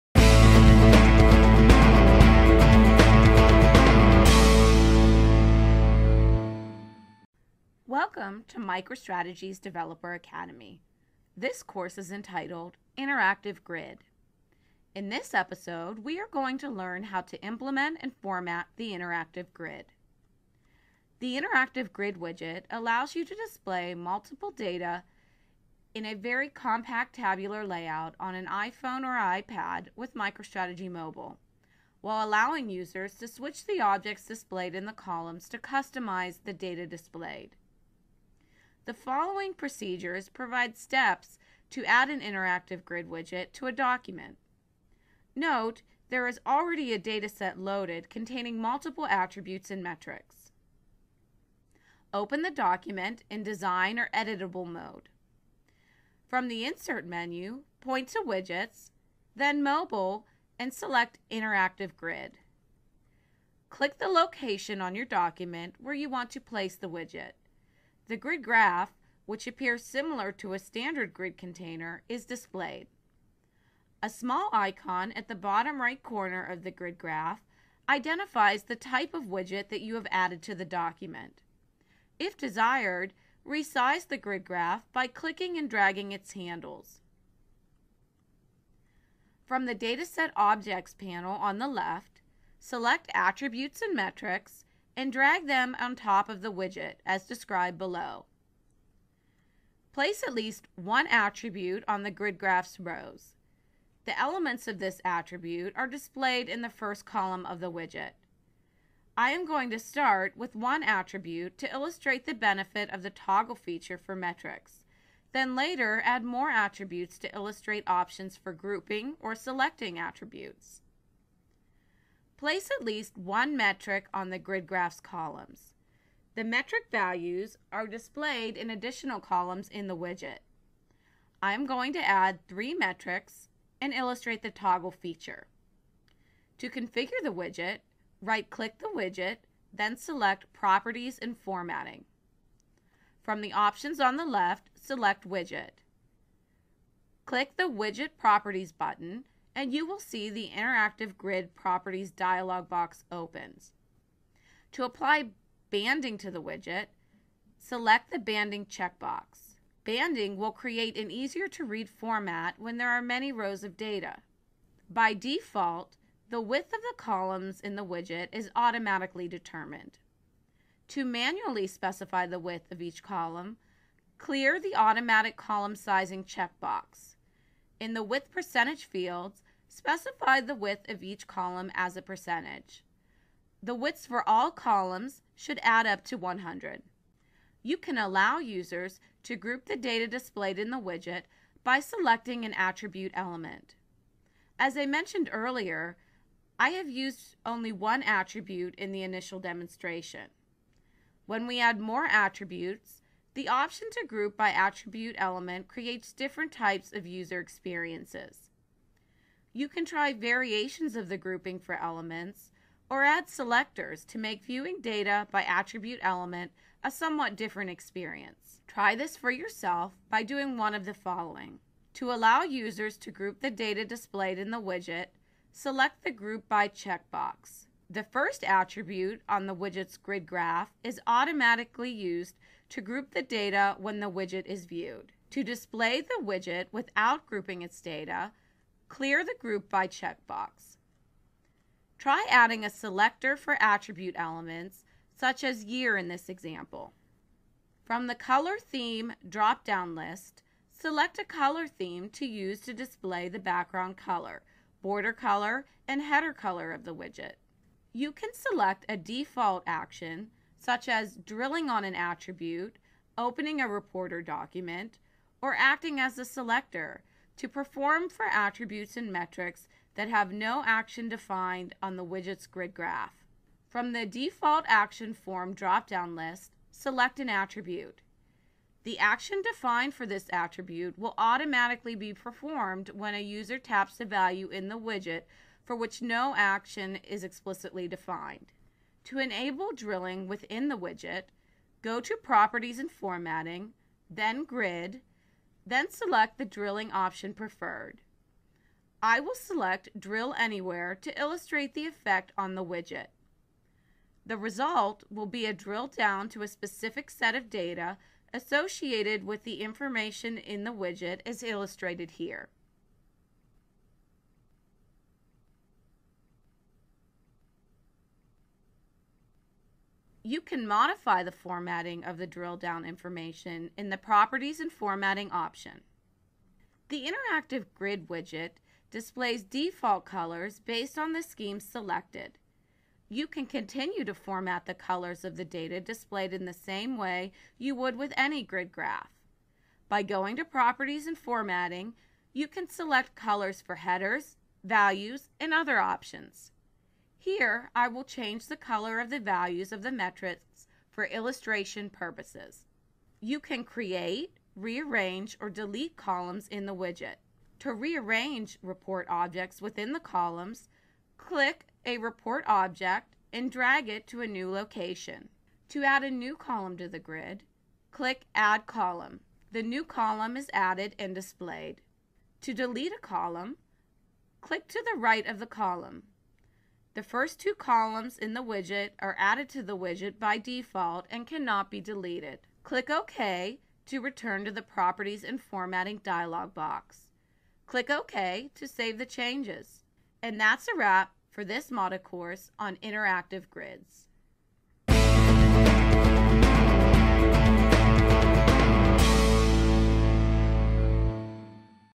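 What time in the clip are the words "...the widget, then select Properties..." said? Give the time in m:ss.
2:18.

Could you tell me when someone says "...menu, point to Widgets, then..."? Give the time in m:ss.
0:57.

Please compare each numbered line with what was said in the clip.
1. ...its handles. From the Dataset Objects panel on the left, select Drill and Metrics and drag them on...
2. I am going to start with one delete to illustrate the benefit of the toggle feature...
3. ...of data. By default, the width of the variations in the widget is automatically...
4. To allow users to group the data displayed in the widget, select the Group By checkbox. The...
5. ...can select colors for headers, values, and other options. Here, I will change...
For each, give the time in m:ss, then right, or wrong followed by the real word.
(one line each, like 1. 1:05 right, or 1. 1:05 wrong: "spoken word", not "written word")
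1. 1:26 wrong: "Attributes", not "Drill"
2. 1:49 wrong: "attribute", not "delete"
3. 2:43 wrong: "columns", not "variations"
4. 3:41 right
5. 5:42 right.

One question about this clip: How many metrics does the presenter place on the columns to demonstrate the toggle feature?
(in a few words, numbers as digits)
3.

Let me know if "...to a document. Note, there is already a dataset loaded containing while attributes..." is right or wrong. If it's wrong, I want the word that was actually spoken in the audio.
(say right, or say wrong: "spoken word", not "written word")
wrong: "multiple", not "while".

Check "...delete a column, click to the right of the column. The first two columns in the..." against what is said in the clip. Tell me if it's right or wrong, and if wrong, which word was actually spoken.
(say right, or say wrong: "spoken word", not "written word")
right.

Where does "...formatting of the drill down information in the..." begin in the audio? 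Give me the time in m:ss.
5:21.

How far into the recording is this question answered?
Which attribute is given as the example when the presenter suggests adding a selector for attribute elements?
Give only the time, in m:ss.
4:05.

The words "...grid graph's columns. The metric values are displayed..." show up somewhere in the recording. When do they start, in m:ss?
2:04.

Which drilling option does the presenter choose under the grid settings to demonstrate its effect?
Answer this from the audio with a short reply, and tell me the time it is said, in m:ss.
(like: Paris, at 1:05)
Drill Anywhere, at 4:59.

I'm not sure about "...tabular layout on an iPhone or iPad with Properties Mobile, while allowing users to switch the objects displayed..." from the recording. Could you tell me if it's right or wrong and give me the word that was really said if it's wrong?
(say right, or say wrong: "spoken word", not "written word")
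wrong: "MicroStrategy", not "Properties".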